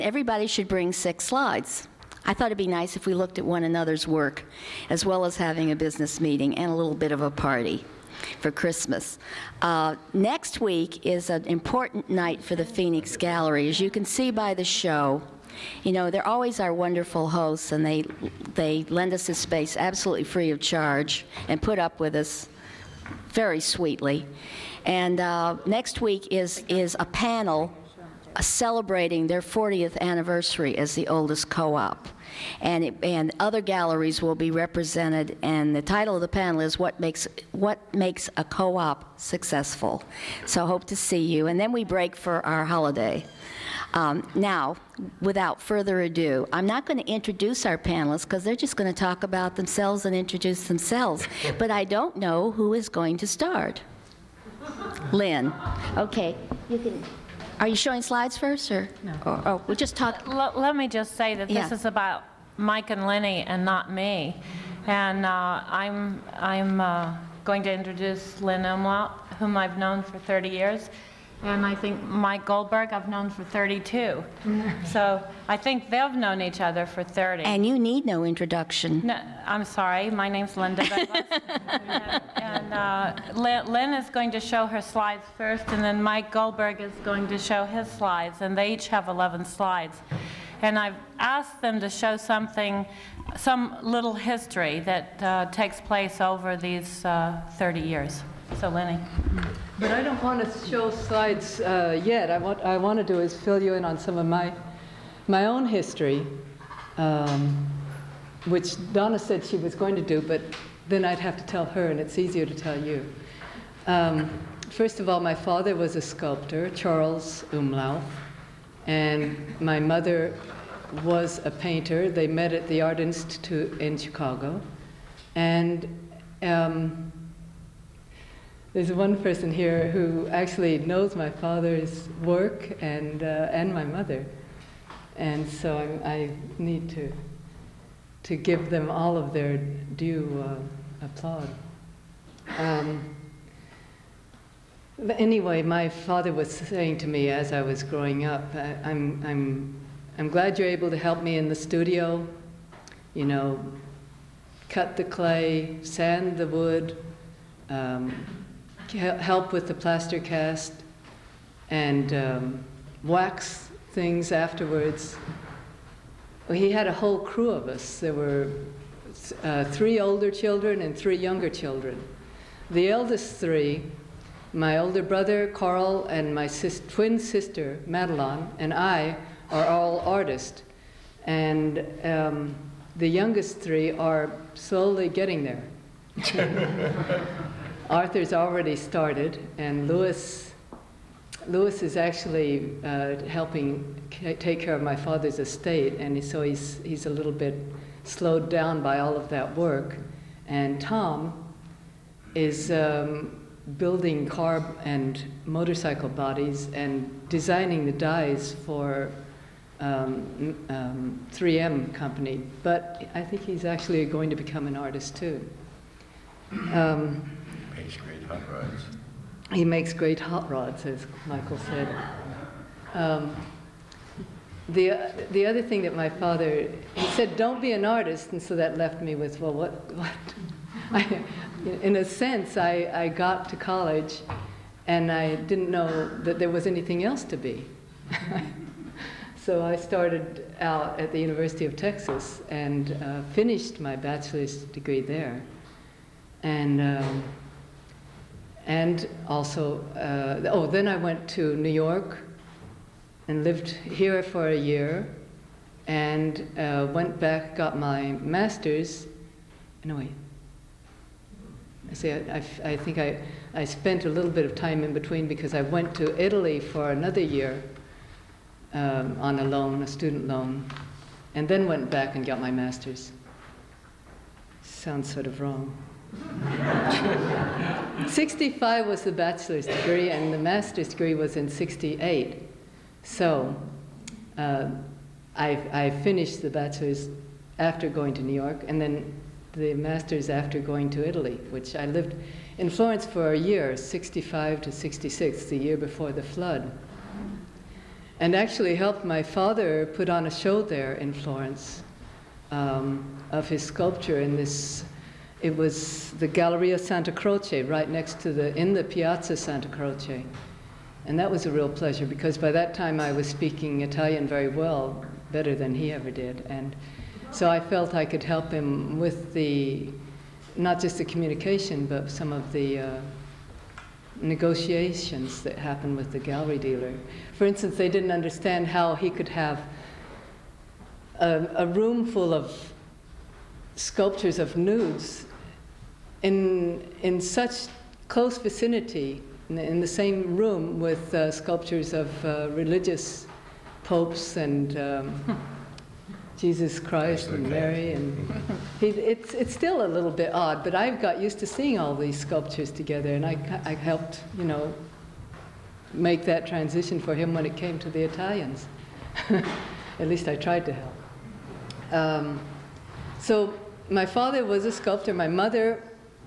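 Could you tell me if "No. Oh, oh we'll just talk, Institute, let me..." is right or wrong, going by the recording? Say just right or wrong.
wrong.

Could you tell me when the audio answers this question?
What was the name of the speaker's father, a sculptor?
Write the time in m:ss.
1:56.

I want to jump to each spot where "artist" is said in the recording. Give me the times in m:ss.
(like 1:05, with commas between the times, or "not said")
2:59, 3:34, 3:47.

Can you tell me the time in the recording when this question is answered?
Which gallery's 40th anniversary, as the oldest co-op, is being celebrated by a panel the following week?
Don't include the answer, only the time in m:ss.
0:12.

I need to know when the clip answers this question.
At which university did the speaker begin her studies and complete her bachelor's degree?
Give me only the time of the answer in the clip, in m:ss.
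4:01.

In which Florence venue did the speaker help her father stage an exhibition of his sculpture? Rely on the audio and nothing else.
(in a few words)
Galleria Santa Croce.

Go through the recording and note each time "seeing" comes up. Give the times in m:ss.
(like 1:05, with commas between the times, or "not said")
5:51.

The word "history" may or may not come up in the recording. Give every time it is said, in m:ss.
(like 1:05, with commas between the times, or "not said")
1:34, 1:45.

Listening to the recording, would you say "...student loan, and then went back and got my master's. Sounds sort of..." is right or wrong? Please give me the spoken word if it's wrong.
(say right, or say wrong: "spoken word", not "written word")
right.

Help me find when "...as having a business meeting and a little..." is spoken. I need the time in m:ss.
0:05.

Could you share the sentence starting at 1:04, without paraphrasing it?
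And uh, I'm, I'm uh, going to introduce Lynn Umlauf, whom I've known for 30 years.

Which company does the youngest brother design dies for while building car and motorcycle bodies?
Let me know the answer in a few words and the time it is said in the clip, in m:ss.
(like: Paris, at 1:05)
3M, at 3:31.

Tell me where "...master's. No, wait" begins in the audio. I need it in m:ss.
4:18.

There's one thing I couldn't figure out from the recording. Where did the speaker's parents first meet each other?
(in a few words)
Art Institute in Chicago.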